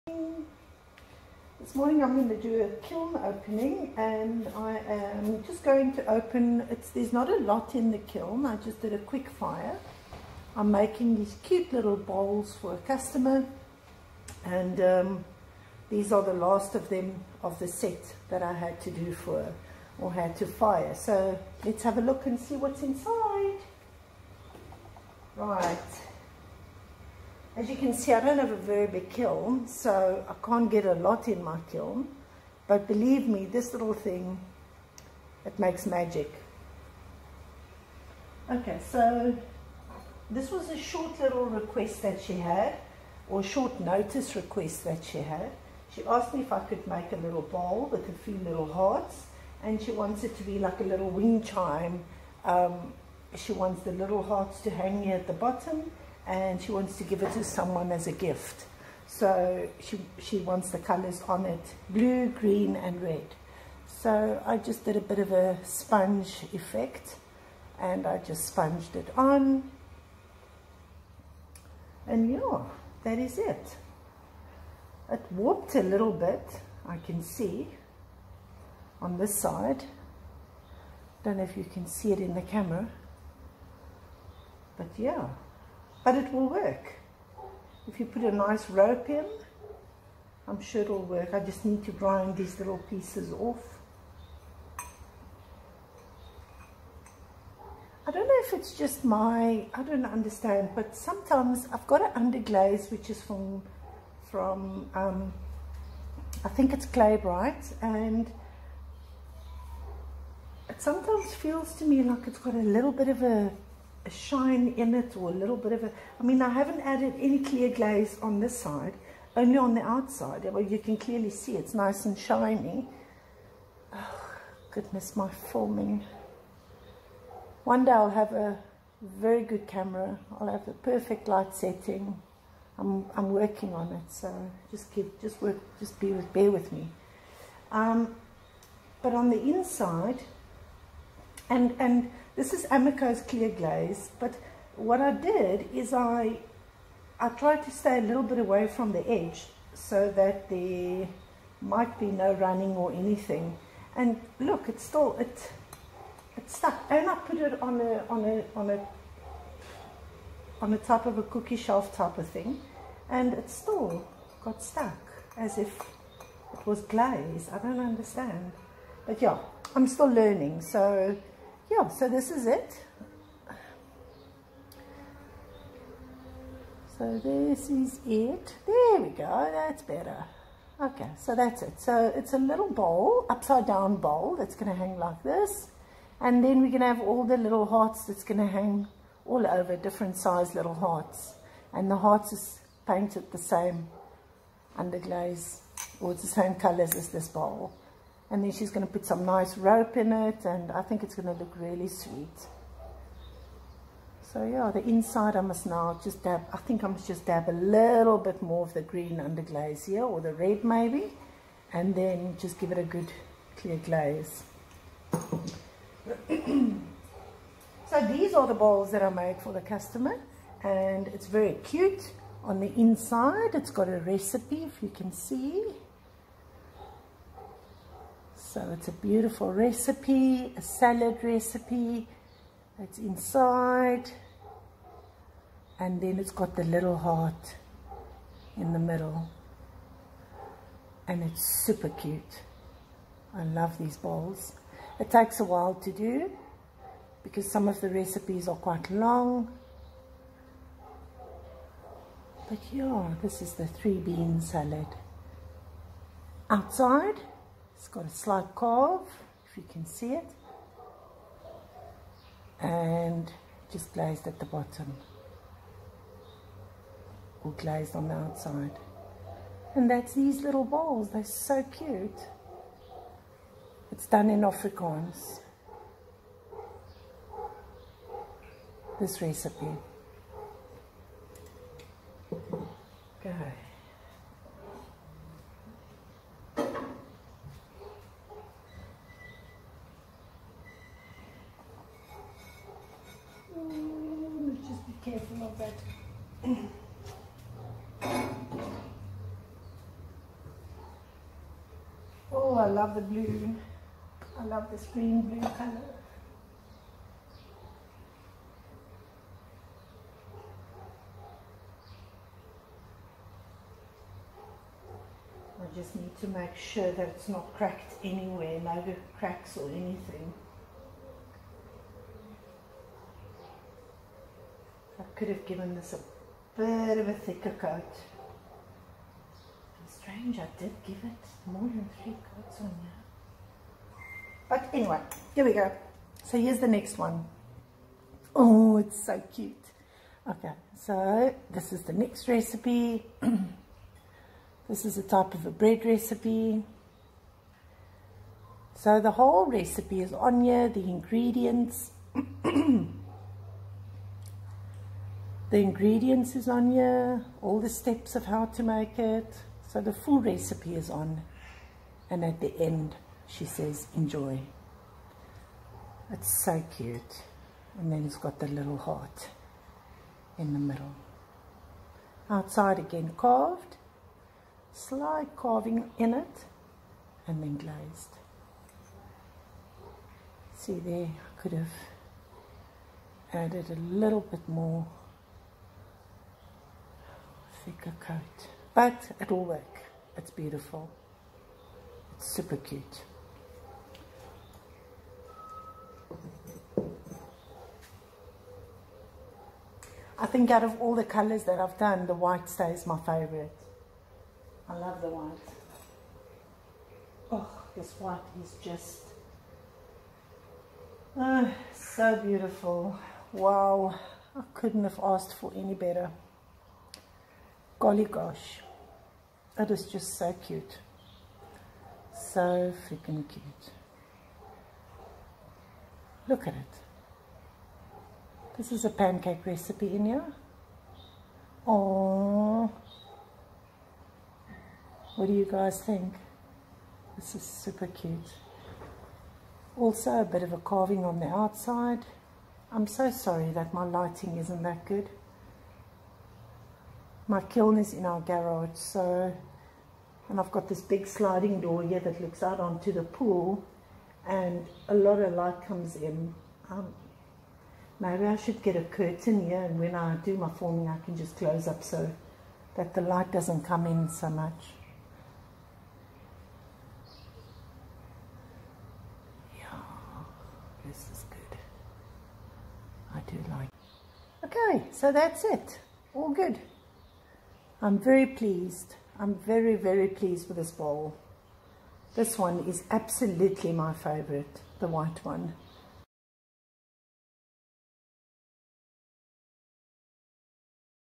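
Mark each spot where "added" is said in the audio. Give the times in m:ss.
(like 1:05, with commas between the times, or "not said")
1:56, 6:23.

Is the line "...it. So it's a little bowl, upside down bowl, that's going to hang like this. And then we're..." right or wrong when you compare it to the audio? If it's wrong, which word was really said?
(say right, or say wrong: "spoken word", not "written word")
right.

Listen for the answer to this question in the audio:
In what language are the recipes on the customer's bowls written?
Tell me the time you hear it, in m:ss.
4:34.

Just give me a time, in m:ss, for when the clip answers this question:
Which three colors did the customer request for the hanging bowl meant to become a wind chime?
1:01.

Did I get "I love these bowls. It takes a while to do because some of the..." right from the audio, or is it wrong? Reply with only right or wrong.
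right.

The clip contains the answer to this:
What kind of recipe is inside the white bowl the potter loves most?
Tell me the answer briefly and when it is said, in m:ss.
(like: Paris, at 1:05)
pancake, at 7:08.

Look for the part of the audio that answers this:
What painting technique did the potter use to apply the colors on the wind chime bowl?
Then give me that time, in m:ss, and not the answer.
1:05.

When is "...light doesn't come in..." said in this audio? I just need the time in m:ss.
7:43.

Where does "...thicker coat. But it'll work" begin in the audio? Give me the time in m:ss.
6:27.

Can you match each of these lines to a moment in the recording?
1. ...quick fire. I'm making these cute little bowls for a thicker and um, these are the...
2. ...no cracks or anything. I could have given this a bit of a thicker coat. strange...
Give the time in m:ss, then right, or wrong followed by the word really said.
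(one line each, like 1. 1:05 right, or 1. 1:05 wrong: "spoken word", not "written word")
1. 0:08 wrong: "customer", not "thicker"
2. 5:18 right.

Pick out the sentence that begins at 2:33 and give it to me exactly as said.
And look, it's still, it, it's stuck.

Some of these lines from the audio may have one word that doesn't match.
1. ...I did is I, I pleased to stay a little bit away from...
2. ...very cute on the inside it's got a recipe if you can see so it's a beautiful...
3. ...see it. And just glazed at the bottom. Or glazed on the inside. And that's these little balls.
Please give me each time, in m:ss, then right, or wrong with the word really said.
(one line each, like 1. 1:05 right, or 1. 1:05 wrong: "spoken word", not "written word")
1. 2:25 wrong: "tried", not "pleased"
2. 3:41 right
3. 4:19 wrong: "outside", not "inside".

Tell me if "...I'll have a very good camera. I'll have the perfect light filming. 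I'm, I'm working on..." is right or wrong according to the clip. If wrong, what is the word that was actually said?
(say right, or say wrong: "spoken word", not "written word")
wrong: "setting", not "filming".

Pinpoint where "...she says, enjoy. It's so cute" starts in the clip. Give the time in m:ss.
6:03.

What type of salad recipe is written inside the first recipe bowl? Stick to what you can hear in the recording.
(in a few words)
three bean salad.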